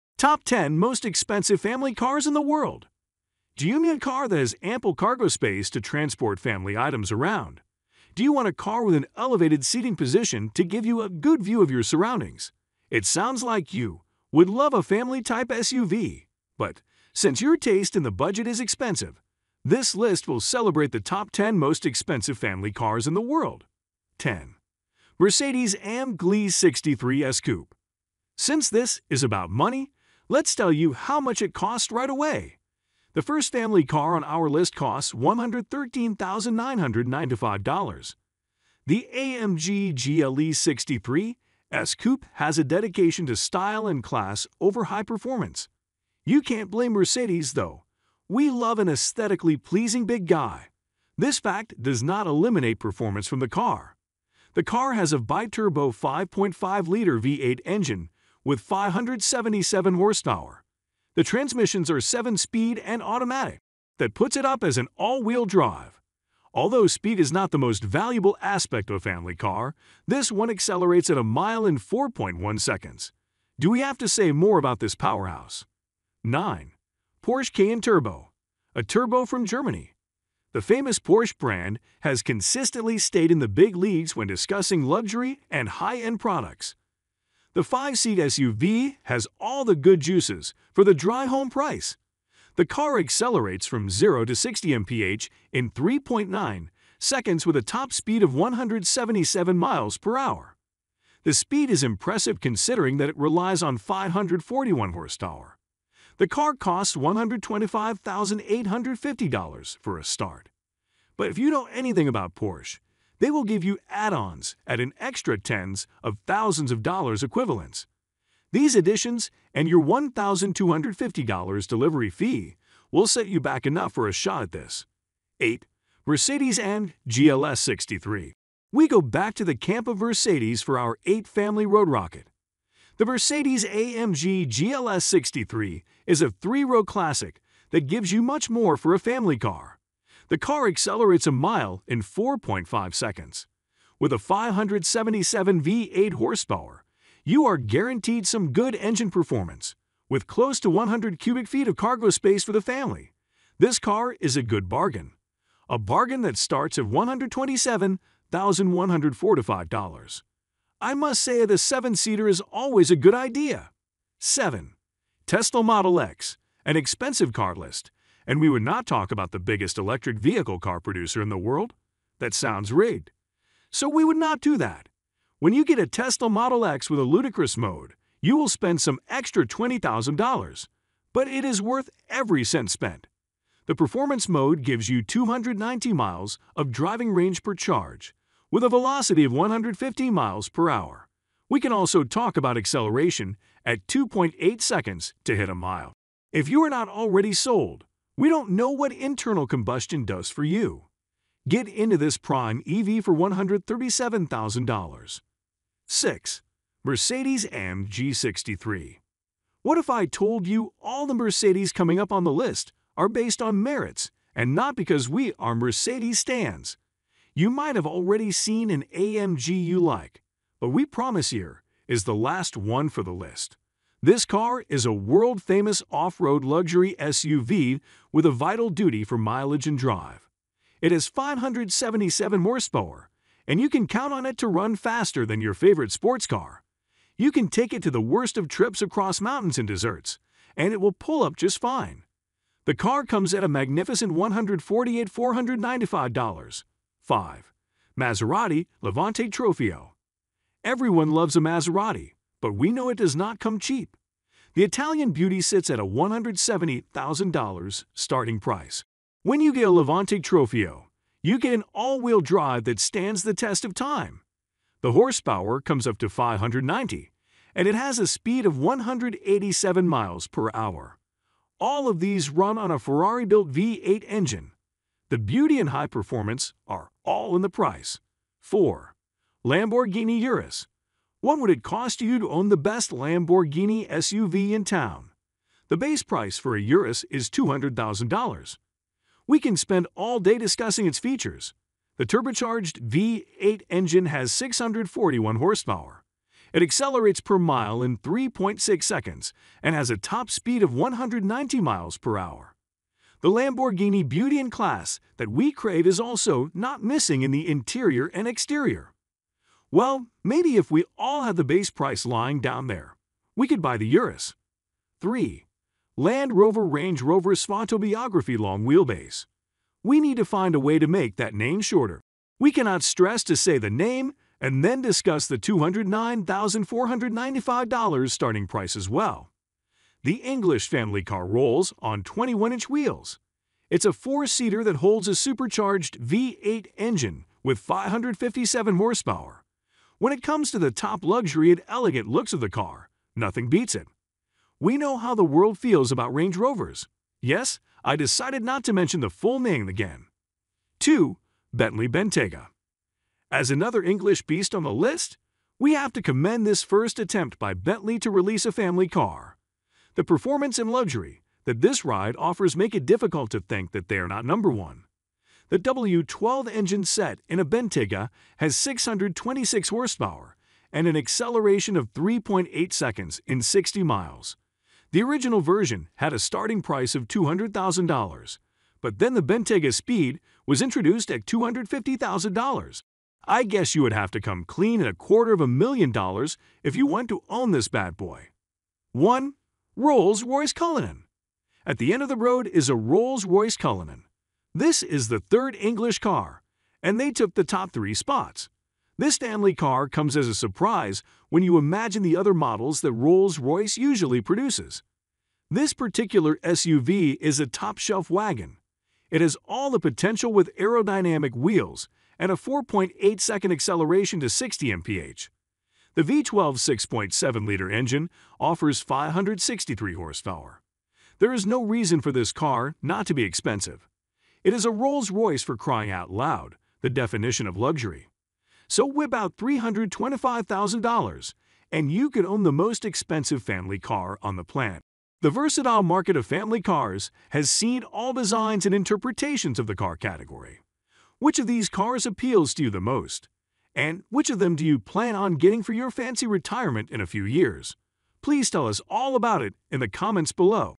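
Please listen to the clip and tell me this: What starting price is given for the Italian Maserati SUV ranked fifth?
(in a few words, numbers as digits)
$170,000.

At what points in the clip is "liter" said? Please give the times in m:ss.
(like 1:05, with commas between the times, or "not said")
0:56, 6:56.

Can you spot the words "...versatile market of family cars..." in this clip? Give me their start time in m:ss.
7:15.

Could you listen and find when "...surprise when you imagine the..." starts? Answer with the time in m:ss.
6:40.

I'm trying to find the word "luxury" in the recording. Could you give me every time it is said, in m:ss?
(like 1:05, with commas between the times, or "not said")
1:24, 3:46, 5:41, 6:00, 7:07.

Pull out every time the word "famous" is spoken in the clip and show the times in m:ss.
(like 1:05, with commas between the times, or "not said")
1:20, 3:44.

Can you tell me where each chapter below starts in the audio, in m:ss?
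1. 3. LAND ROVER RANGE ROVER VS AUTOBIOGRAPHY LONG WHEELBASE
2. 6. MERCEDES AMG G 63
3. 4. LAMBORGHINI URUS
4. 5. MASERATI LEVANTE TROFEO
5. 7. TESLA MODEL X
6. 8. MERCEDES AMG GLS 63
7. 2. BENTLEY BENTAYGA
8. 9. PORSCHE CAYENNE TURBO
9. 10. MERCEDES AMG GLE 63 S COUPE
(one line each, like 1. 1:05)
1. 5:15
2. 3:26
3. 4:39
4. 4:08
5. 2:44
6. 2:06
7. 5:51
8. 1:16
9. 0:25.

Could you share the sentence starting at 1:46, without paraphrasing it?
The car costs $125,850 for a start.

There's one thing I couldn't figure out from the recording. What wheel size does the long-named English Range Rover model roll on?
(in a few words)
21-inch.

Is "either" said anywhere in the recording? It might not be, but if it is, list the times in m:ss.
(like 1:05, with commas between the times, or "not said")
not said.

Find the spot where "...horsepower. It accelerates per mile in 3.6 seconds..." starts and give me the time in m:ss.
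4:55.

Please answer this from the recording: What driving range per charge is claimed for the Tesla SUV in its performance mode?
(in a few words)
290 miles.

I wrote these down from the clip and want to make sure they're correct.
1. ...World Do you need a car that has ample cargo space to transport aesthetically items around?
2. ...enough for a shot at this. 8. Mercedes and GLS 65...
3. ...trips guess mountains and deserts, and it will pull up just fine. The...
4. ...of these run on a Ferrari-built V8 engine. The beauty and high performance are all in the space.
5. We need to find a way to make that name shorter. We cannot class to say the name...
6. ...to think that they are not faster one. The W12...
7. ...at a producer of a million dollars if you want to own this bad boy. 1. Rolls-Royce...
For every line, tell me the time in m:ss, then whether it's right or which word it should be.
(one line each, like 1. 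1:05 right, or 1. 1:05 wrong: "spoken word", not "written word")
1. 0:02 wrong: "family", not "aesthetically"
2. 2:03 wrong: "63", not "65"
3. 3:58 wrong: "across", not "guess"
4. 4:31 wrong: "price", not "space"
5. 5:19 wrong: "stress", not "class"
6. 6:03 wrong: "number", not "faster"
7. 6:24 wrong: "quarter", not "producer".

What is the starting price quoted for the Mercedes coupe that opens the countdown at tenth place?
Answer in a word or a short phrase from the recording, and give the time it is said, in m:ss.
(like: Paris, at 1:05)
$113,995, at 0:35.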